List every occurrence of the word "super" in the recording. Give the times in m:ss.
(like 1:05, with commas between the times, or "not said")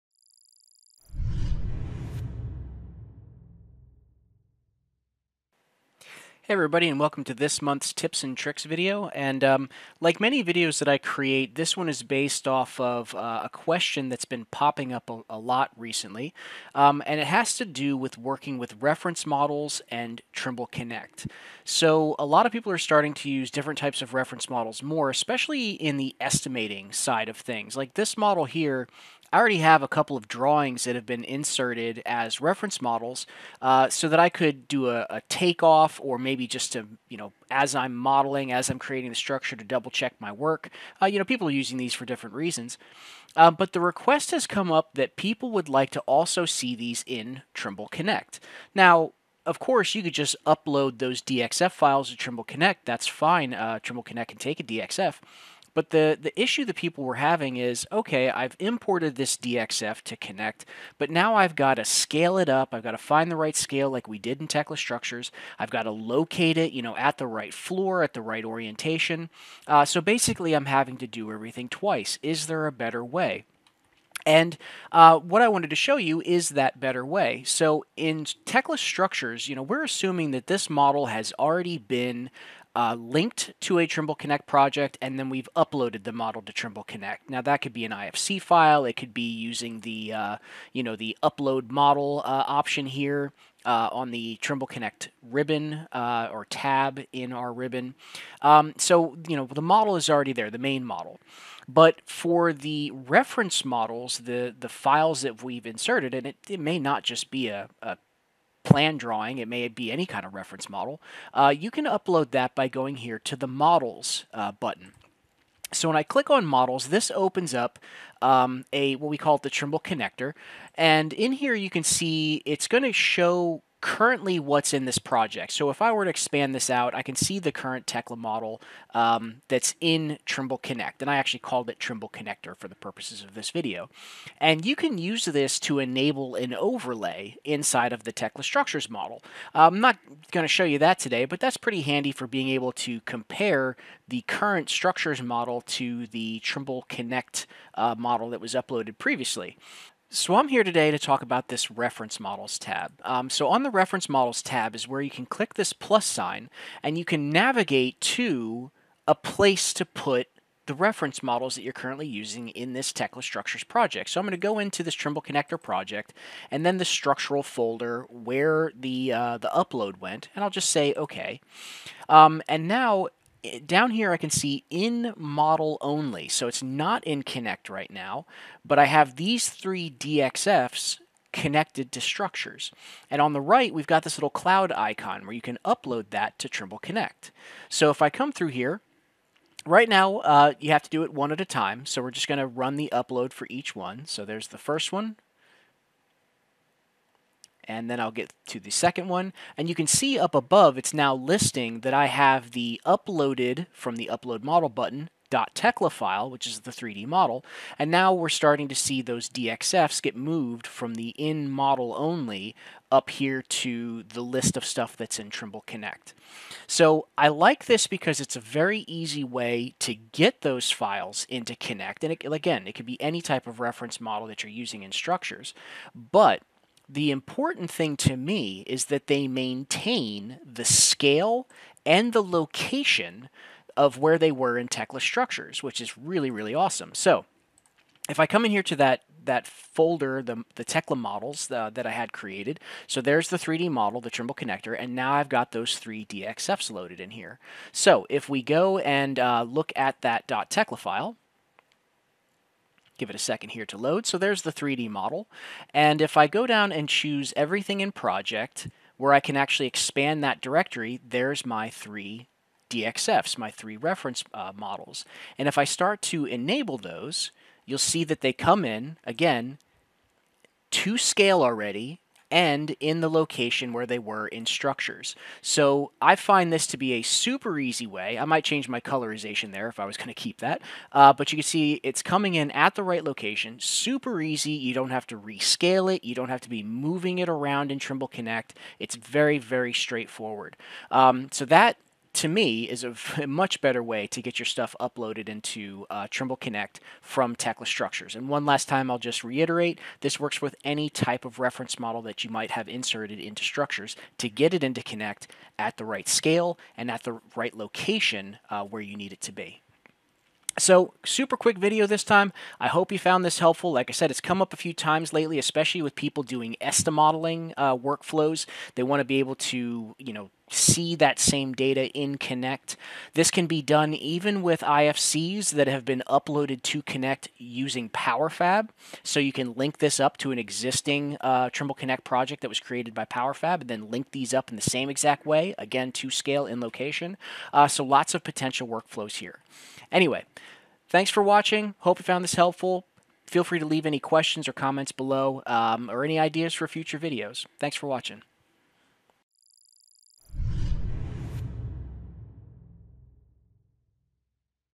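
4:37, 4:43, 5:11.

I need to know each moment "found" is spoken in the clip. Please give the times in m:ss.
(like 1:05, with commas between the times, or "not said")
5:12, 5:42.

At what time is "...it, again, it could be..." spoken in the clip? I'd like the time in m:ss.
3:42.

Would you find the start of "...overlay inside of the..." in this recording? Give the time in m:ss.
2:16.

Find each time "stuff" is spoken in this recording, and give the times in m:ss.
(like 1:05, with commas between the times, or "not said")
3:34, 4:54.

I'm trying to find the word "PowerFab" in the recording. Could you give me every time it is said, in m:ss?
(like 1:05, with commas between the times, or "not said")
5:27, 5:33.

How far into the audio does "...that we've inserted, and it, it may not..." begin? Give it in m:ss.
1:45.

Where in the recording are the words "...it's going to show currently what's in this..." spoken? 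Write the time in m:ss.
2:02.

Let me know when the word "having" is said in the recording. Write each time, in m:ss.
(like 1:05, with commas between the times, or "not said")
0:57, 1:10.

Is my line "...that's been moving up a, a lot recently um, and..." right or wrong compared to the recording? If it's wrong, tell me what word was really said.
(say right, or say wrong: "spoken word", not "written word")
wrong: "popping", not "moving".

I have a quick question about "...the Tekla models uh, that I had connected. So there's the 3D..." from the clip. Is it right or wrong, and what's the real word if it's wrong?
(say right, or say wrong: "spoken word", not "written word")
wrong: "created", not "connected".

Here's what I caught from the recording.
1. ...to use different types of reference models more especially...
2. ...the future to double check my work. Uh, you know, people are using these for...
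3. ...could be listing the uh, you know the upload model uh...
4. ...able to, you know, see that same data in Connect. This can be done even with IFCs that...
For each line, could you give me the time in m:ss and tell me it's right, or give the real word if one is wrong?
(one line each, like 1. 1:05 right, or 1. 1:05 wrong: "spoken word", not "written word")
1. 0:23 right
2. 0:39 wrong: "structure", not "future"
3. 1:28 wrong: "using", not "listing"
4. 5:19 right.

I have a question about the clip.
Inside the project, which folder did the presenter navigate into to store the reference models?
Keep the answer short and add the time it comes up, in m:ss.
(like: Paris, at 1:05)
structural folder, at 2:46.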